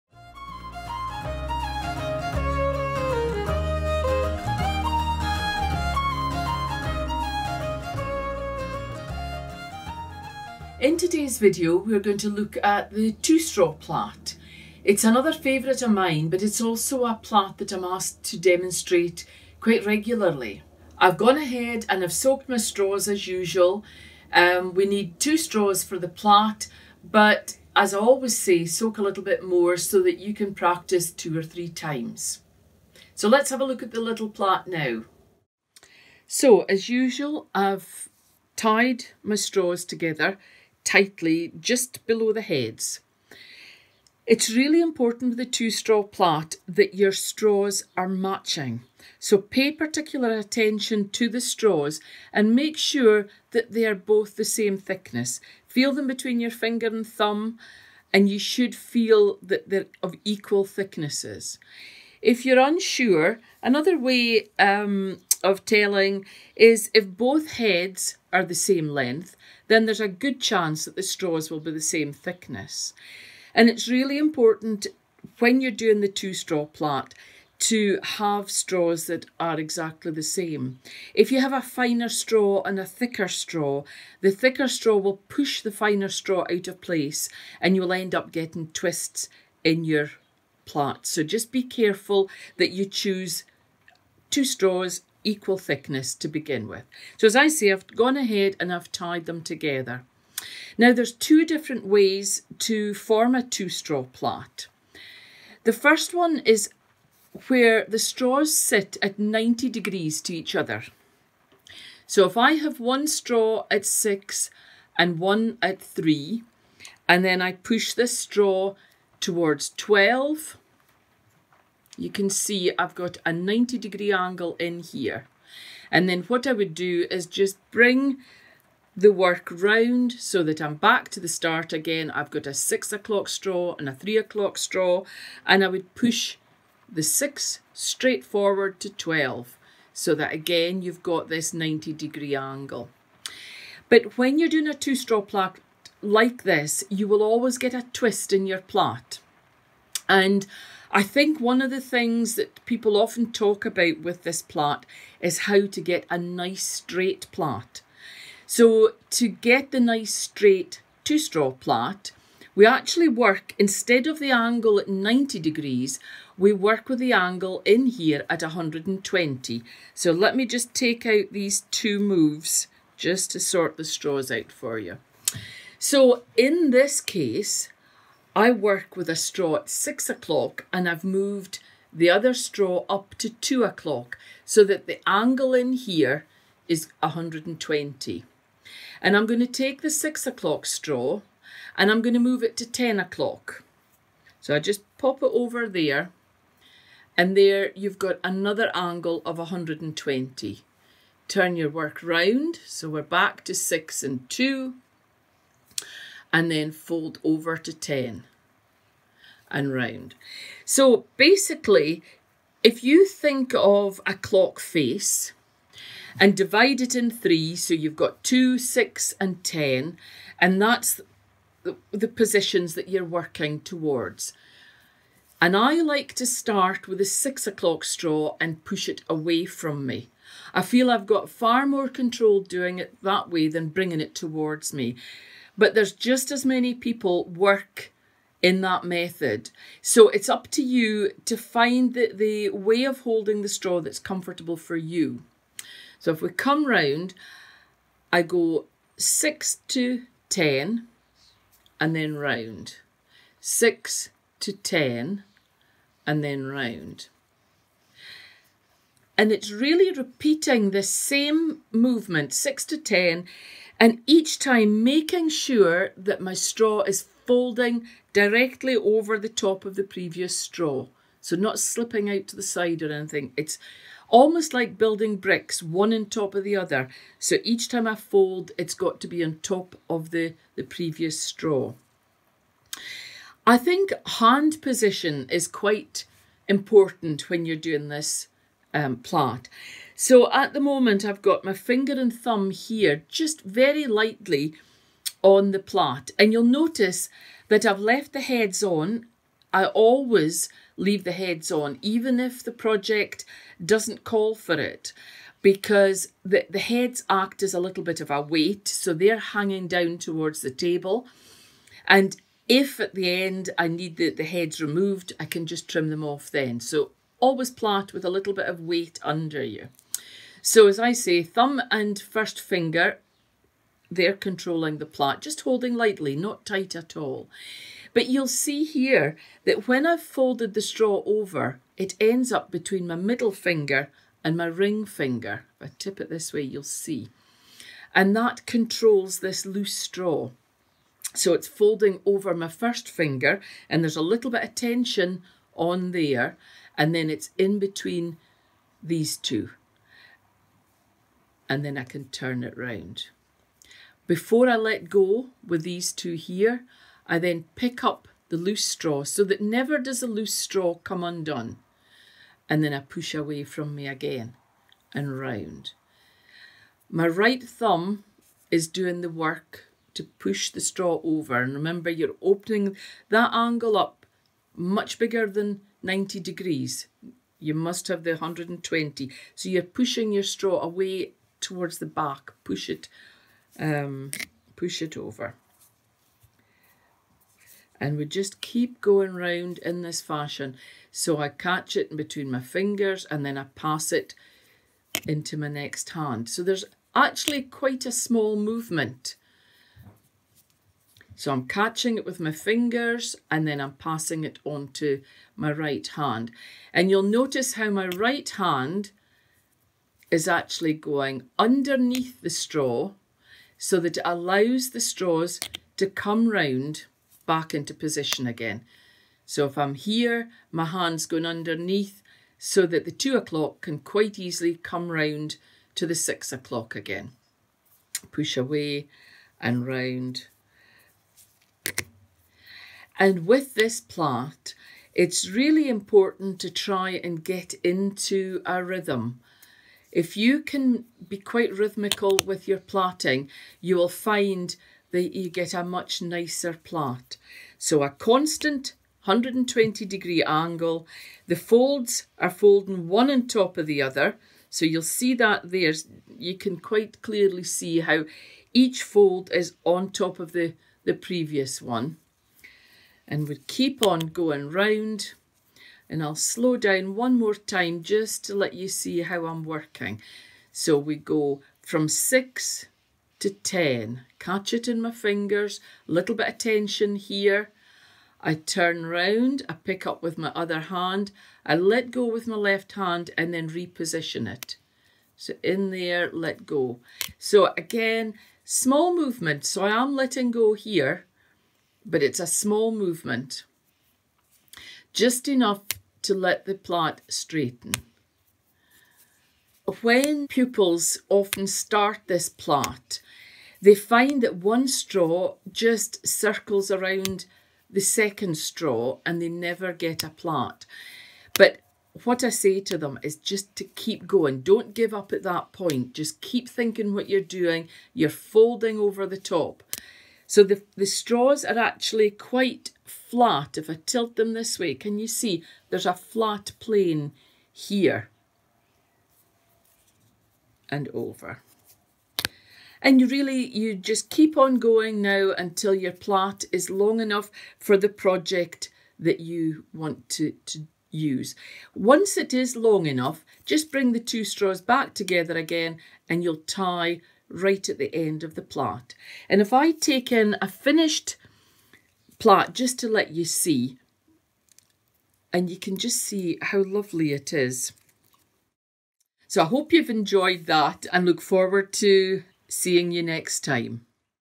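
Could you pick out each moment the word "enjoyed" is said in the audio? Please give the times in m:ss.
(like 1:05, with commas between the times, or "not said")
9:19.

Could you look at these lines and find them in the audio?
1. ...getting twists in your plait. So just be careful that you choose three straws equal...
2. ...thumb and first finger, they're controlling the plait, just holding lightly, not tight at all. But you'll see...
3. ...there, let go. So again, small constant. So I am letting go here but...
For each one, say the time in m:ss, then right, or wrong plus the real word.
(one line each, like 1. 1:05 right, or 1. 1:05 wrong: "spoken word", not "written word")
1. 1:28 wrong: "two", not "three"
2. 5:21 right
3. 8:05 wrong: "movement", not "constant".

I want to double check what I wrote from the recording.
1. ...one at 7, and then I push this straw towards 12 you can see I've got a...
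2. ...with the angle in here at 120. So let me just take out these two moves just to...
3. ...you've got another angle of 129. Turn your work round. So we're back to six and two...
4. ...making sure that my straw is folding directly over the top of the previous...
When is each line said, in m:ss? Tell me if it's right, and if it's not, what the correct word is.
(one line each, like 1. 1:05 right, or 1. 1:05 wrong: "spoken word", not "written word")
1. 1:55 wrong: "3", not "7"
2. 2:46 right
3. 3:17 wrong: "120", not "129"
4. 4:24 right.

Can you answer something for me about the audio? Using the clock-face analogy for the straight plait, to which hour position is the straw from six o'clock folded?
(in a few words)
10 o'clock.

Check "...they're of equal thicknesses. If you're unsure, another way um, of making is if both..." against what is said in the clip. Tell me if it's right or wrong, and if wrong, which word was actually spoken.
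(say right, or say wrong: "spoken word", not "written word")
wrong: "telling", not "making".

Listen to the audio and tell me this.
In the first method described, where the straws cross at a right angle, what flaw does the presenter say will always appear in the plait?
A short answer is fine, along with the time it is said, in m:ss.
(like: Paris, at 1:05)
a twist, at 2:26.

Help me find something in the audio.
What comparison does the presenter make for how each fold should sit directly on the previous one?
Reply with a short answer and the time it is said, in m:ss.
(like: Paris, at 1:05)
building bricks, at 4:34.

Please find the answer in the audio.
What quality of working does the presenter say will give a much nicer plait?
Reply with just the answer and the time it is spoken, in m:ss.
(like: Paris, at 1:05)
rhythm, at 7:17.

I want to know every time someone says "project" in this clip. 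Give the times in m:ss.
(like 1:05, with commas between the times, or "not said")
5:02, 8:57.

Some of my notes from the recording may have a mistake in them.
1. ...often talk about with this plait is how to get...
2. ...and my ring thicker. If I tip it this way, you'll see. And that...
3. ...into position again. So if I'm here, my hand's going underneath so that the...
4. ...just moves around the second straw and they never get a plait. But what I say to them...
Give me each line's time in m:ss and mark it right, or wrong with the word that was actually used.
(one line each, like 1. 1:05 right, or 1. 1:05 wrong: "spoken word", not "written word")
1. 2:32 right
2. 5:34 wrong: "finger", not "thicker"
3. 6:57 right
4. 8:25 wrong: "circles", not "moves".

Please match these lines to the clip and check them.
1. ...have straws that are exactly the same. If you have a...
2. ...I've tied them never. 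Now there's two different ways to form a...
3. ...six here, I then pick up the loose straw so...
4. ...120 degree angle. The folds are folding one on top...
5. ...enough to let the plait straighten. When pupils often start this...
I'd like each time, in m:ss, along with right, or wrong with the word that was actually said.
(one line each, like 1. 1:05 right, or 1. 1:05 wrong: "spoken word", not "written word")
1. 1:18 right
2. 1:38 wrong: "together", not "never"
3. 5:55 wrong: "two", not "six"
4. 7:29 right
5. 8:15 right.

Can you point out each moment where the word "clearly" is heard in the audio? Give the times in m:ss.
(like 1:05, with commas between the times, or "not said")
7:37.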